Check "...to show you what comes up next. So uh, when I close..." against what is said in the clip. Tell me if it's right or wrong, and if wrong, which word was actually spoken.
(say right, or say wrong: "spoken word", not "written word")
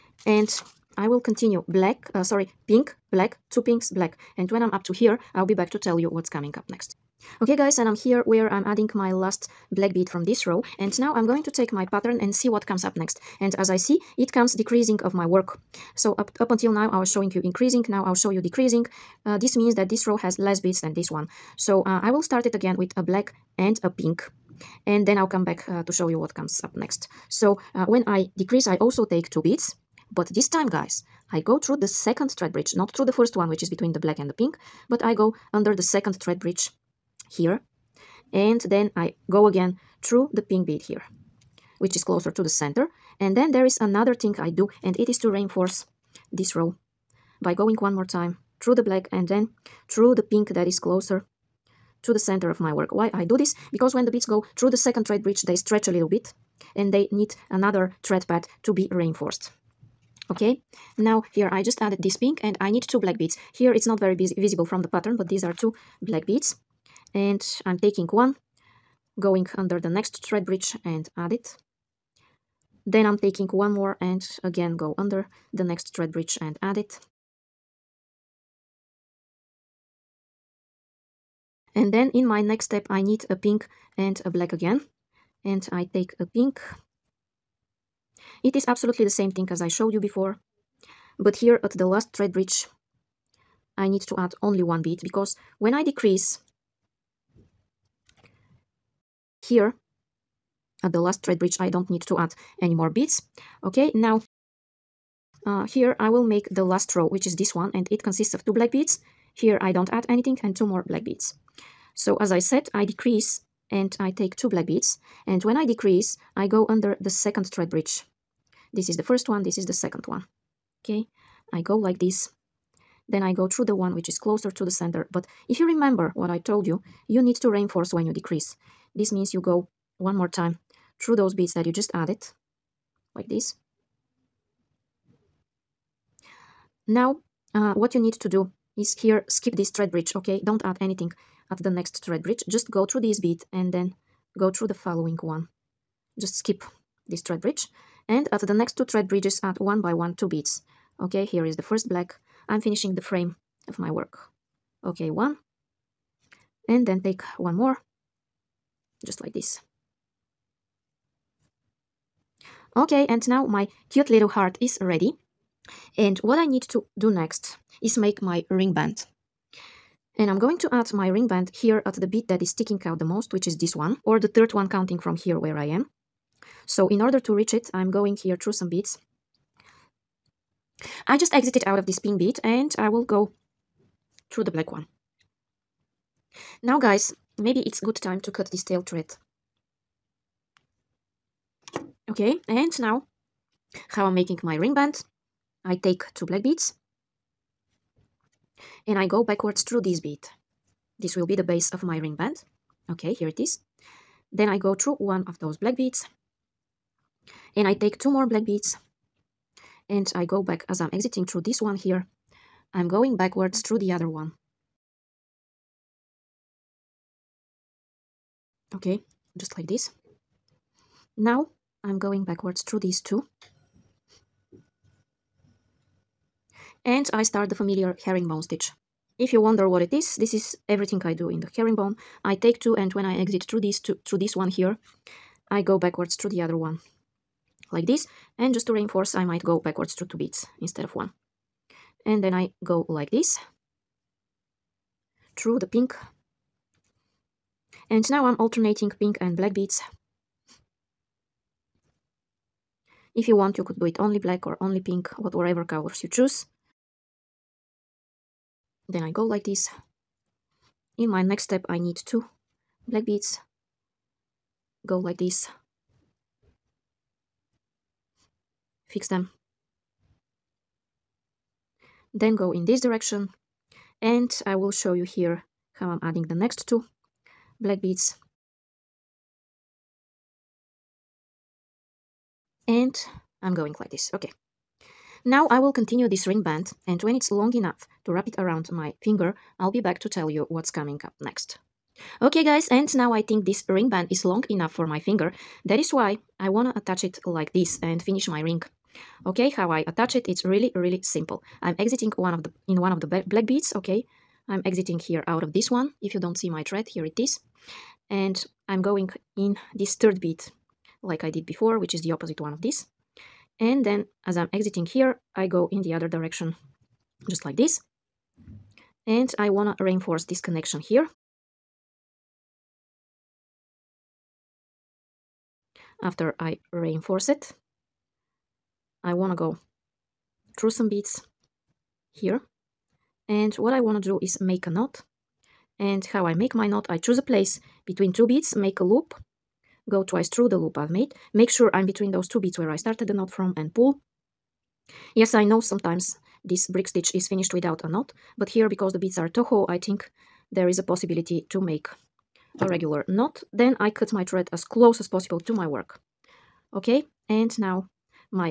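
wrong: "decrease", not "close".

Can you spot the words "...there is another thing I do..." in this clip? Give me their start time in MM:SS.
00:43.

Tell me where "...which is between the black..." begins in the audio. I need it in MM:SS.
00:33.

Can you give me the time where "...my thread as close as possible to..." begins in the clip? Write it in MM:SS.
05:54.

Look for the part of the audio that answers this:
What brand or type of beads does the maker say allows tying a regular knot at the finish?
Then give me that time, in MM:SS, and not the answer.
05:49.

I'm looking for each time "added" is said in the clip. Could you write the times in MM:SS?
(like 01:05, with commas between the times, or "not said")
01:01, 02:11.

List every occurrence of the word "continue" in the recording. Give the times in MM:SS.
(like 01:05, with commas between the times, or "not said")
00:01, 04:45.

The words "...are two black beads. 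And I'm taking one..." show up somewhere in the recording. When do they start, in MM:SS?
01:05.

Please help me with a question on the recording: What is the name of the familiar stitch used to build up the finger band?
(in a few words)
Herringbone stitch.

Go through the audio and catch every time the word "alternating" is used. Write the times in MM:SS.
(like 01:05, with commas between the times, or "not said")
04:08.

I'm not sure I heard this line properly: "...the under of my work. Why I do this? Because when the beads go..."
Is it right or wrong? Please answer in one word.
wrong.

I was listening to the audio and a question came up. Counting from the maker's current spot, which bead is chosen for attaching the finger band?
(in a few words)
The third one.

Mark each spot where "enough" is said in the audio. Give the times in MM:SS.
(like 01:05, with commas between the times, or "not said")
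04:47, 04:54.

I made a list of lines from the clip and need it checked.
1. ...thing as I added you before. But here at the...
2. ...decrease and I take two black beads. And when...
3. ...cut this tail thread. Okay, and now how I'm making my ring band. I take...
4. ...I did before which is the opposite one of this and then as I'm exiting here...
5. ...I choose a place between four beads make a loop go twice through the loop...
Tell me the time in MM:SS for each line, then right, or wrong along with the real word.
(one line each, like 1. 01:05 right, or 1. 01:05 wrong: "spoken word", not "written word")
1. 01:29 wrong: "showed", not "added"
2. 01:52 right
3. 03:08 right
4. 05:11 right
5. 05:36 wrong: "two", not "four".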